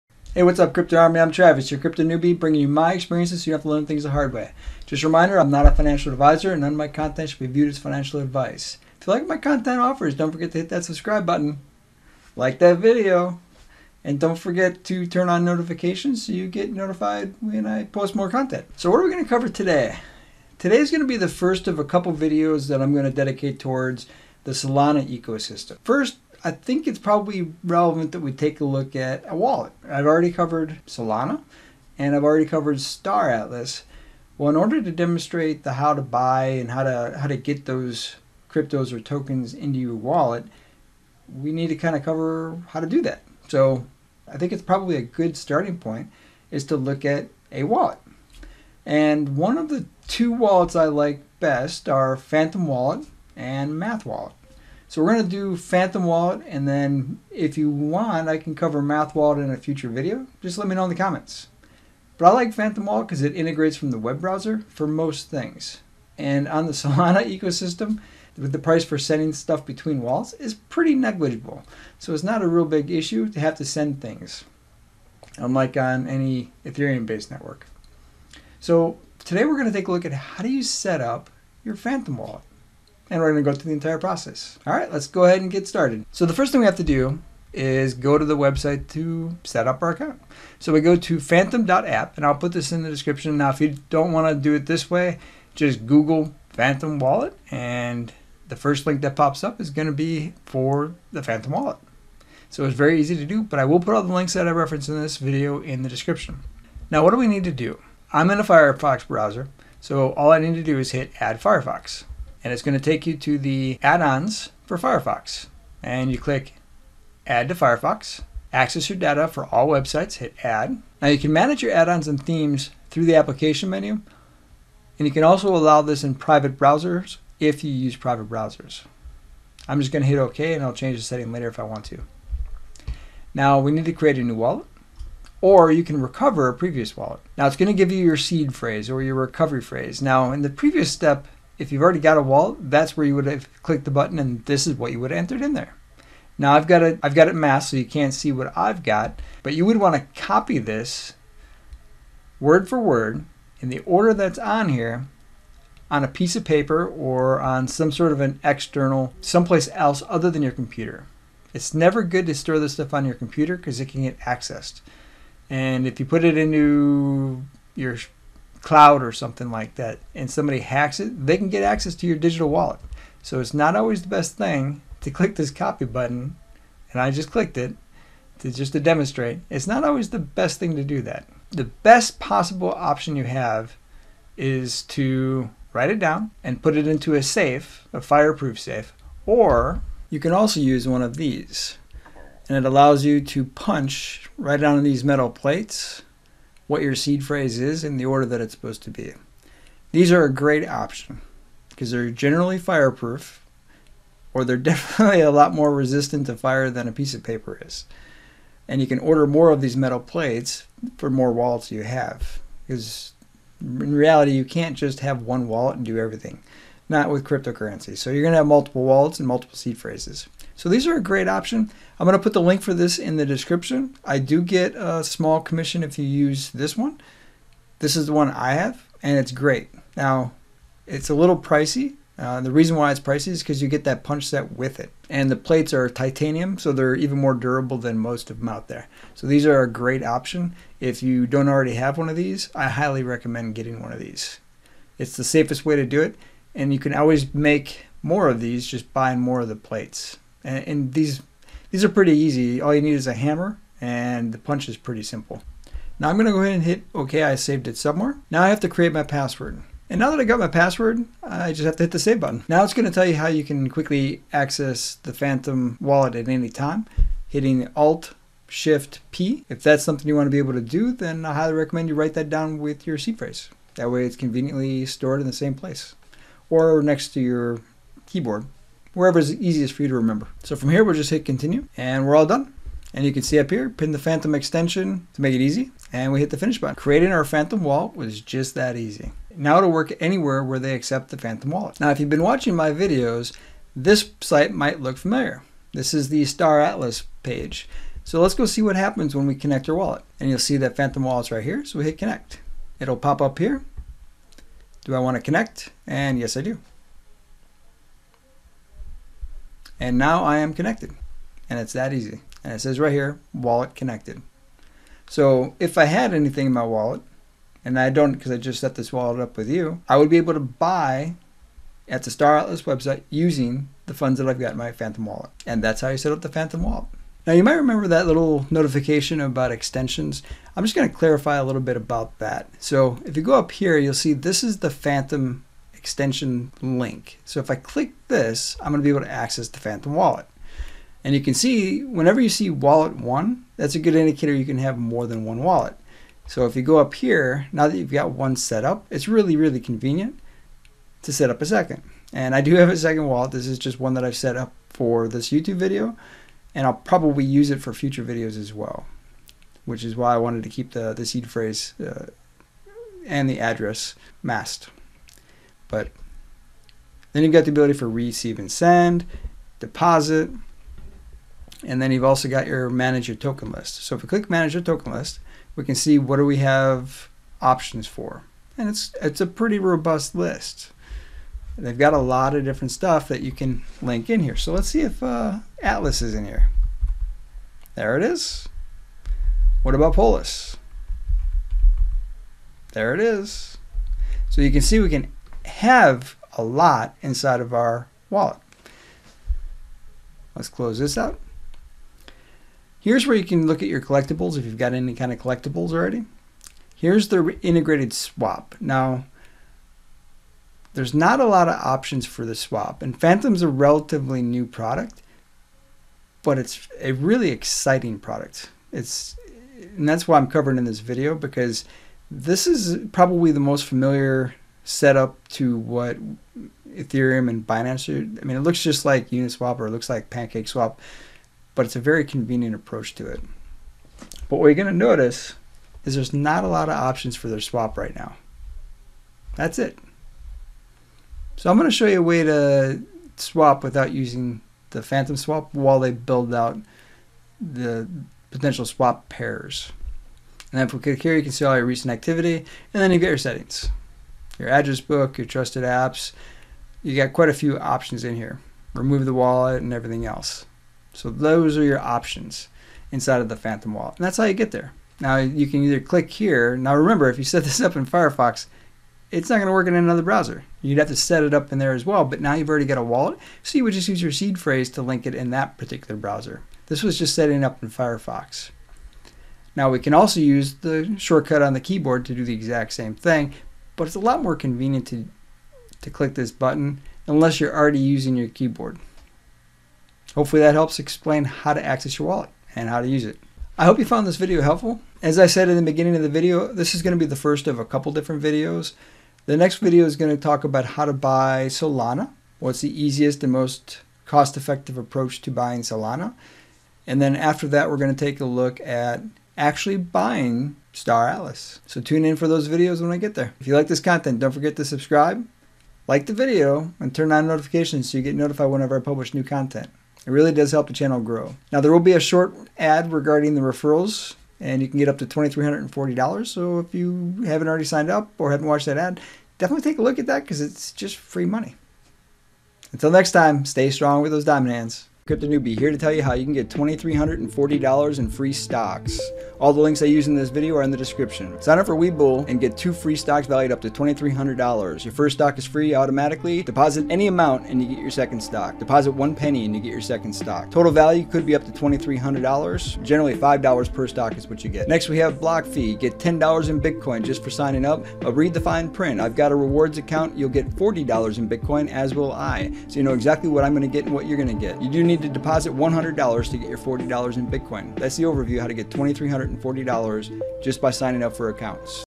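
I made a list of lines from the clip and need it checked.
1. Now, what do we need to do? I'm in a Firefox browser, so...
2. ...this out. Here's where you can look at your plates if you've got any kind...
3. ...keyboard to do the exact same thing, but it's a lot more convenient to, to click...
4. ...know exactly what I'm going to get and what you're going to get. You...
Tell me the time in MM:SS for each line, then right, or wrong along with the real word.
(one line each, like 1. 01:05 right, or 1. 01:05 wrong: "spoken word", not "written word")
1. 01:46 right
2. 06:40 wrong: "collectibles", not "plates"
3. 08:01 right
4. 09:22 right.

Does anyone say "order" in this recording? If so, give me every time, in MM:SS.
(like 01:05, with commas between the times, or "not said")
00:34, 02:33, 03:18, 03:28.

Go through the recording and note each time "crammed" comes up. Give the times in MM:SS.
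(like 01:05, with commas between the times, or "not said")
not said.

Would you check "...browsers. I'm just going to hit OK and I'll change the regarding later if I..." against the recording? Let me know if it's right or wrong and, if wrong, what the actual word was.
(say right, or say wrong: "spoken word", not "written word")
wrong: "setting", not "regarding".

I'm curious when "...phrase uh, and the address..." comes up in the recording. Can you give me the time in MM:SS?
06:01.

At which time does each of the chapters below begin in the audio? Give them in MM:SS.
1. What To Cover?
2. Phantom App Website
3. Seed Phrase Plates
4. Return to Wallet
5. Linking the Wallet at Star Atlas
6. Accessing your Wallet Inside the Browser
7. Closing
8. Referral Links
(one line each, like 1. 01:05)
1. 00:20
2. 01:25
3. 03:10
4. 04:15
5. 04:51
6. 05:27
7. 08:13
8. 08:54.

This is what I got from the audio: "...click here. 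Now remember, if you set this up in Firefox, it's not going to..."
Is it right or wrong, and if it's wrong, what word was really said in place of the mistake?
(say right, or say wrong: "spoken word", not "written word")
right.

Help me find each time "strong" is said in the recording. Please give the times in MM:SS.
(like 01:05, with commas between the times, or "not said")
08:53.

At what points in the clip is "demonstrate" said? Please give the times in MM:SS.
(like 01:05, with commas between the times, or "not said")
00:34, 02:58.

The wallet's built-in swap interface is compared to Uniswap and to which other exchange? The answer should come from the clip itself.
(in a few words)
PancakeSwap.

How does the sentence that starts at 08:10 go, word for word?
Hopefully that helps explain how to access your wallet and how to use it.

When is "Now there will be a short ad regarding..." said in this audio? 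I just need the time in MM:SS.
08:41.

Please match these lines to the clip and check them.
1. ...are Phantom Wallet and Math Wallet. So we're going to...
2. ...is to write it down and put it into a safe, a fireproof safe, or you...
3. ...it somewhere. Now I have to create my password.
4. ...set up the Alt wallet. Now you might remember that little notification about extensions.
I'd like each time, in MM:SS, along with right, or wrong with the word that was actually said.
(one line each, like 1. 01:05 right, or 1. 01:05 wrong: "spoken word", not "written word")
1. 00:51 right
2. 03:04 right
3. 04:17 right
4. 05:25 wrong: "Phantom", not "Alt".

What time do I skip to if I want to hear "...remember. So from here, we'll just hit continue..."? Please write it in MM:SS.
04:39.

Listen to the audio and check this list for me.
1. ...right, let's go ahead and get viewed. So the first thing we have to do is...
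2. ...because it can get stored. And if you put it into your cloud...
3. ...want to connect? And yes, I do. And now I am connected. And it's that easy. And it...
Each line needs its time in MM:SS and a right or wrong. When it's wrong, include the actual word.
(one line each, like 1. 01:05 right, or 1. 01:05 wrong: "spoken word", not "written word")
1. 01:24 wrong: "started", not "viewed"
2. 02:43 wrong: "accessed", not "stored"
3. 05:04 right.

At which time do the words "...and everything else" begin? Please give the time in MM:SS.
07:39.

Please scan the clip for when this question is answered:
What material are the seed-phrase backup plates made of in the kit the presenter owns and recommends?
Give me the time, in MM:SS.
03:55.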